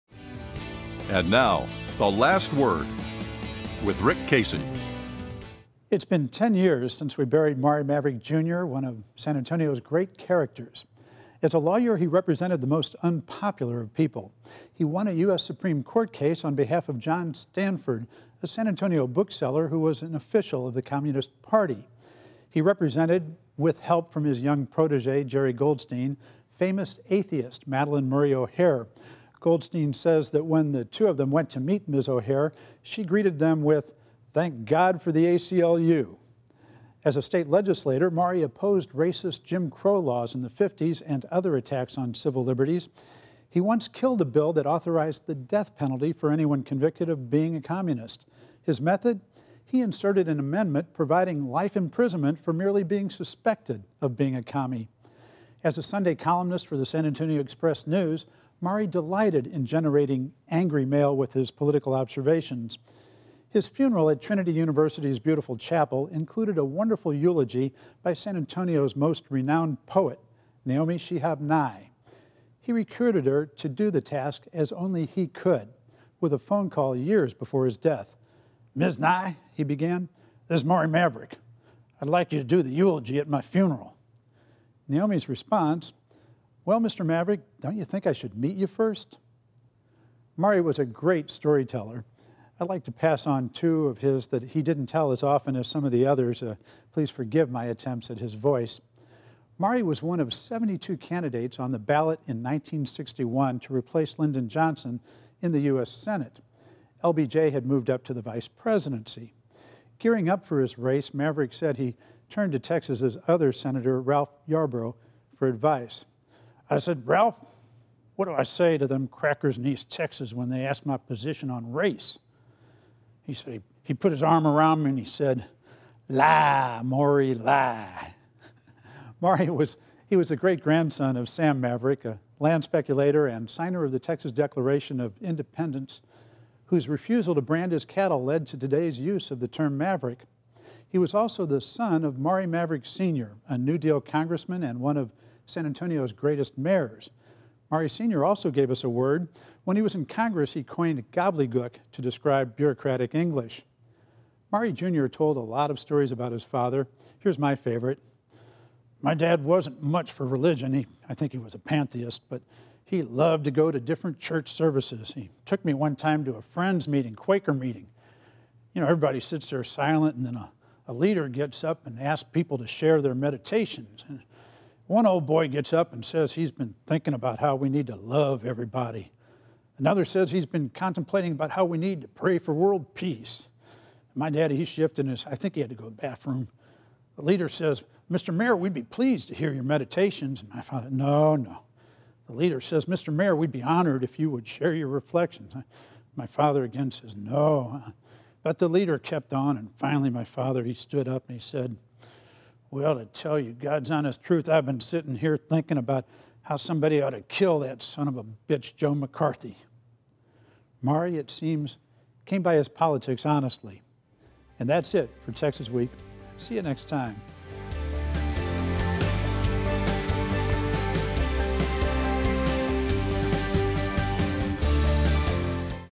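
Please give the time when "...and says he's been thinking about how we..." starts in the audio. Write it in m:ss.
2:55.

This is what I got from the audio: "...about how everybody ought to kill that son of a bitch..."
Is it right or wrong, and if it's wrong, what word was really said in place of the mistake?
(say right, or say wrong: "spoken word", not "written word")
wrong: "somebody", not "everybody".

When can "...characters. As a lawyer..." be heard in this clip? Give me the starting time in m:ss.
0:10.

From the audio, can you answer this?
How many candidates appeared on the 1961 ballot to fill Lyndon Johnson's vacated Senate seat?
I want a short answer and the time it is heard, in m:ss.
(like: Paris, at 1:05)
72, at 1:40.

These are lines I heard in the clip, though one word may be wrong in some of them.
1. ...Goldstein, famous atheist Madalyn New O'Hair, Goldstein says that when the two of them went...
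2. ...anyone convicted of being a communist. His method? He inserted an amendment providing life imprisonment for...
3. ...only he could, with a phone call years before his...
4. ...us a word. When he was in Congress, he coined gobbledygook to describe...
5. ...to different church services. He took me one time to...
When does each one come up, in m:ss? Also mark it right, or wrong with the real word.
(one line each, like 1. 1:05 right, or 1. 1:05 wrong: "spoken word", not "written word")
1. 0:25 wrong: "Murray", not "New"
2. 0:46 right
3. 1:14 right
4. 2:28 right
5. 2:43 right.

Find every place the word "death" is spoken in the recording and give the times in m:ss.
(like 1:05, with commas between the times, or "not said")
0:45, 1:17.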